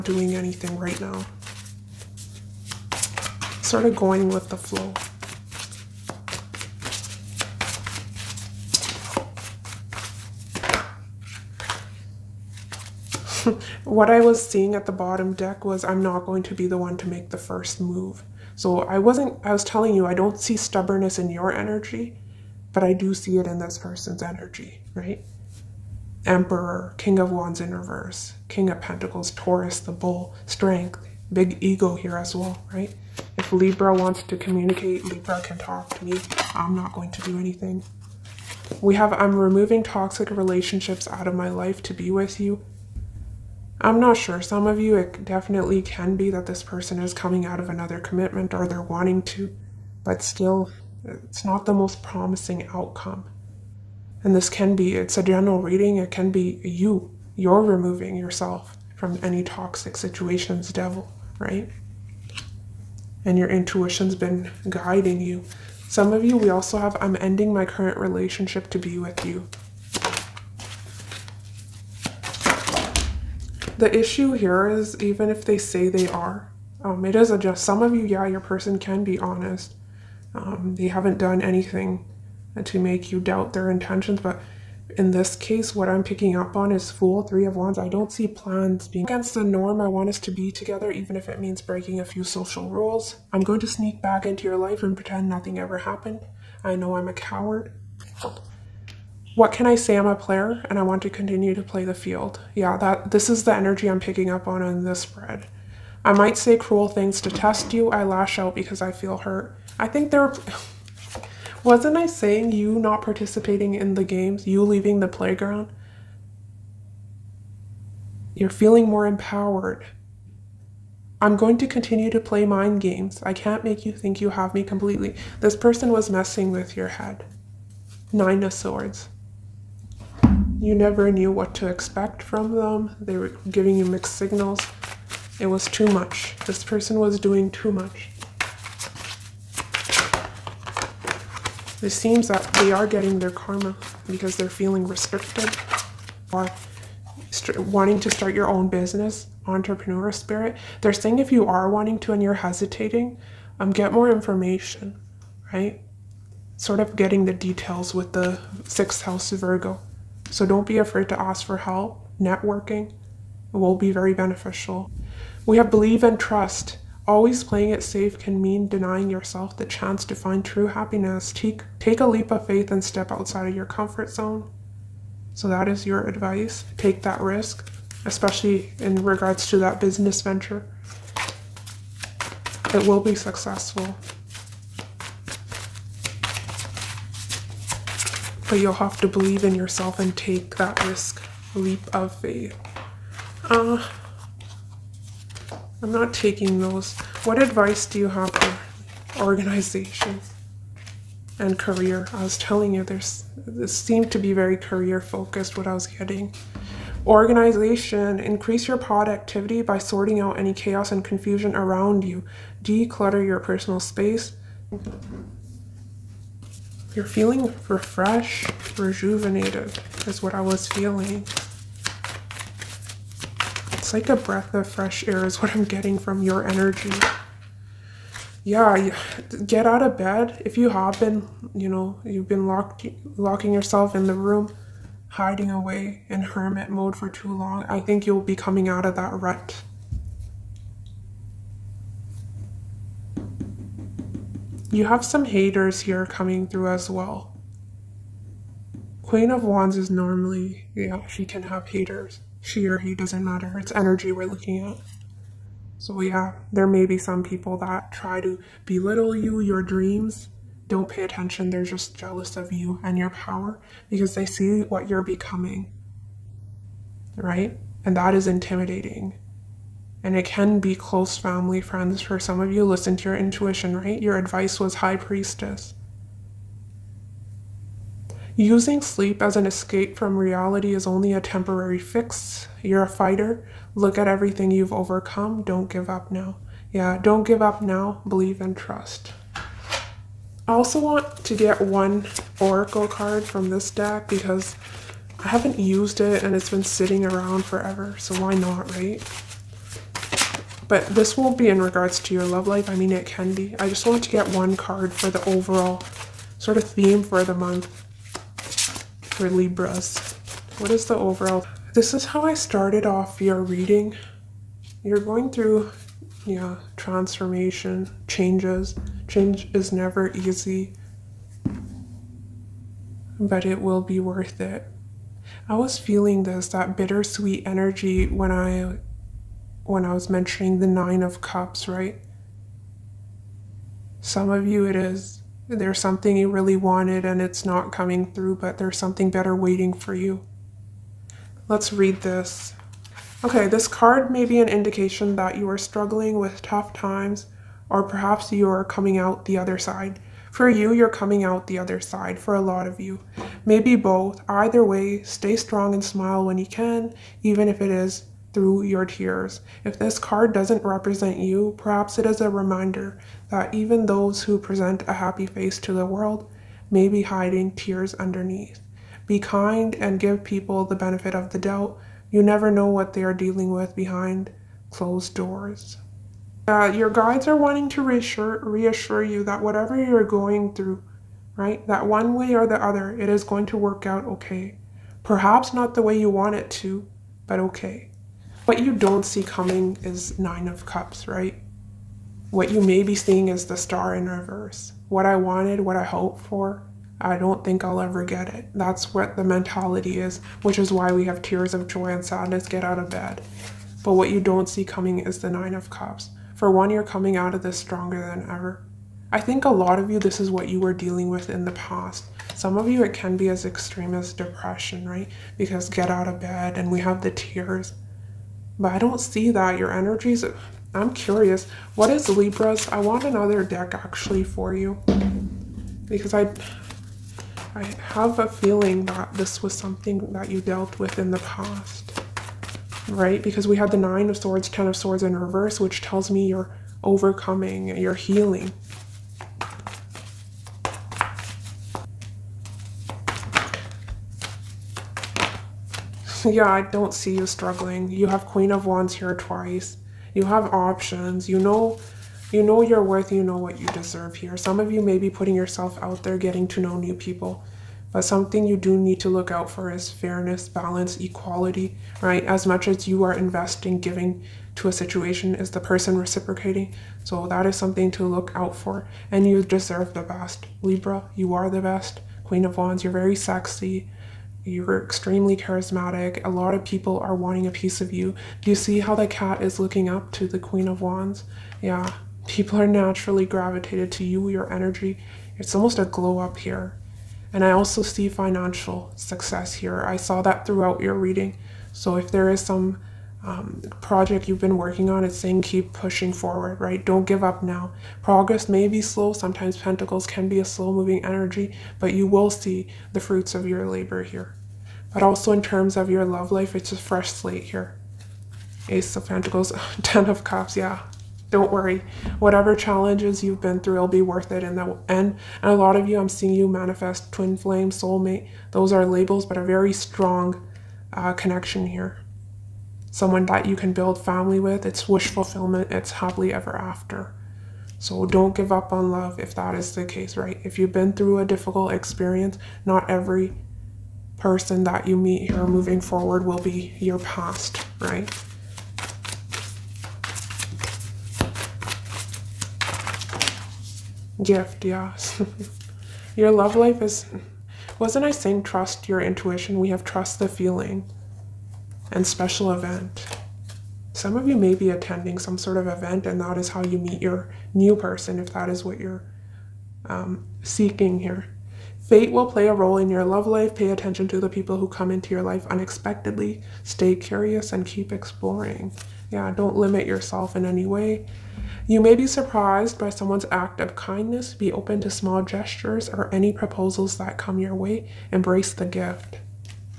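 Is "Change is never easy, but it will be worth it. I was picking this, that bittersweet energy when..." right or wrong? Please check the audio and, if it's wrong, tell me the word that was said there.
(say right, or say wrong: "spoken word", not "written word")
wrong: "feeling", not "picking".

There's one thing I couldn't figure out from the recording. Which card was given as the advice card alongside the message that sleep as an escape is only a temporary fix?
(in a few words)
High Priestess.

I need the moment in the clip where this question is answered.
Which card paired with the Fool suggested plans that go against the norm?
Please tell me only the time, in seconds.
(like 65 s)
87 s.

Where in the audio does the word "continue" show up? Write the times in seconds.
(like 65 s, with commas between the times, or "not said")
101 s, 121 s.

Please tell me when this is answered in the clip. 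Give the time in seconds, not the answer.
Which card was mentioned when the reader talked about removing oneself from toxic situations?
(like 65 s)
60 s.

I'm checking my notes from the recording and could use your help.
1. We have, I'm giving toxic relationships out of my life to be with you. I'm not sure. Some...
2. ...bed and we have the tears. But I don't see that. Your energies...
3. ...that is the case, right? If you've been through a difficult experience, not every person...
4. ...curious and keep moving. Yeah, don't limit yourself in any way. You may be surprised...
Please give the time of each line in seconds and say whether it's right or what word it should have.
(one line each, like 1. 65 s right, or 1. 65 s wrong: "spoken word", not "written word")
1. 38 s wrong: "removing", not "giving"
2. 416 s right
3. 529 s right
4. 566 s wrong: "exploring", not "moving".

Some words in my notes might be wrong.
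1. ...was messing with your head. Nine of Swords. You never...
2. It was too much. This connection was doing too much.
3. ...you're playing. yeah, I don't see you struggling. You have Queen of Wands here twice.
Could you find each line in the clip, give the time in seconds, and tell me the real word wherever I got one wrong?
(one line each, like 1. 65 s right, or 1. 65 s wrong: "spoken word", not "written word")
1. 125 s right
2. 135 s wrong: "person", not "connection"
3. 437 s wrong: "healing", not "playing".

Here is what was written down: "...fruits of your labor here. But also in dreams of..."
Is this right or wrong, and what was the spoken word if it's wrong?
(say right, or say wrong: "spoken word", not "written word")
wrong: "terms", not "dreams".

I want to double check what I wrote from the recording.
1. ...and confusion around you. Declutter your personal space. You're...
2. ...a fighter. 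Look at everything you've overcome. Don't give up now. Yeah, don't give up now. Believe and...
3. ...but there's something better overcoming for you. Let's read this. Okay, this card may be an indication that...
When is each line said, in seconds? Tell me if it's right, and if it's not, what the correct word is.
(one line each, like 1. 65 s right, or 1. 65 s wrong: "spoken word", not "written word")
1. 210 s right
2. 282 s right
3. 338 s wrong: "waiting", not "overcoming".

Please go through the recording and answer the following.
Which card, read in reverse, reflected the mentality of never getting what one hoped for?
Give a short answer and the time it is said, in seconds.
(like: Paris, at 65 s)
The Star, at 393 s.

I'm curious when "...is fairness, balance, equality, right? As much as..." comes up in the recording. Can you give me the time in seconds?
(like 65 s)
459 s.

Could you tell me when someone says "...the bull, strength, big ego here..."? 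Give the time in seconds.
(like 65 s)
29 s.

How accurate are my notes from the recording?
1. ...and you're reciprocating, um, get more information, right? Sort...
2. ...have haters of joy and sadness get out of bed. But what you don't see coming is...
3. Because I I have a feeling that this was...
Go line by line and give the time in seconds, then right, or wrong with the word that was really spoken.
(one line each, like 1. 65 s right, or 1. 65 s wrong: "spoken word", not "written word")
1. 152 s wrong: "hesitating", not "reciprocating"
2. 401 s wrong: "tears", not "haters"
3. 425 s right.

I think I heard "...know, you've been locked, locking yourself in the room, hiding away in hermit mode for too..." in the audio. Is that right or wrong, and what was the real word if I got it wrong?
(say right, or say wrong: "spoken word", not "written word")
right.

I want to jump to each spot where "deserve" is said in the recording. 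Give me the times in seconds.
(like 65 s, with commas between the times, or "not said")
453 s, 469 s.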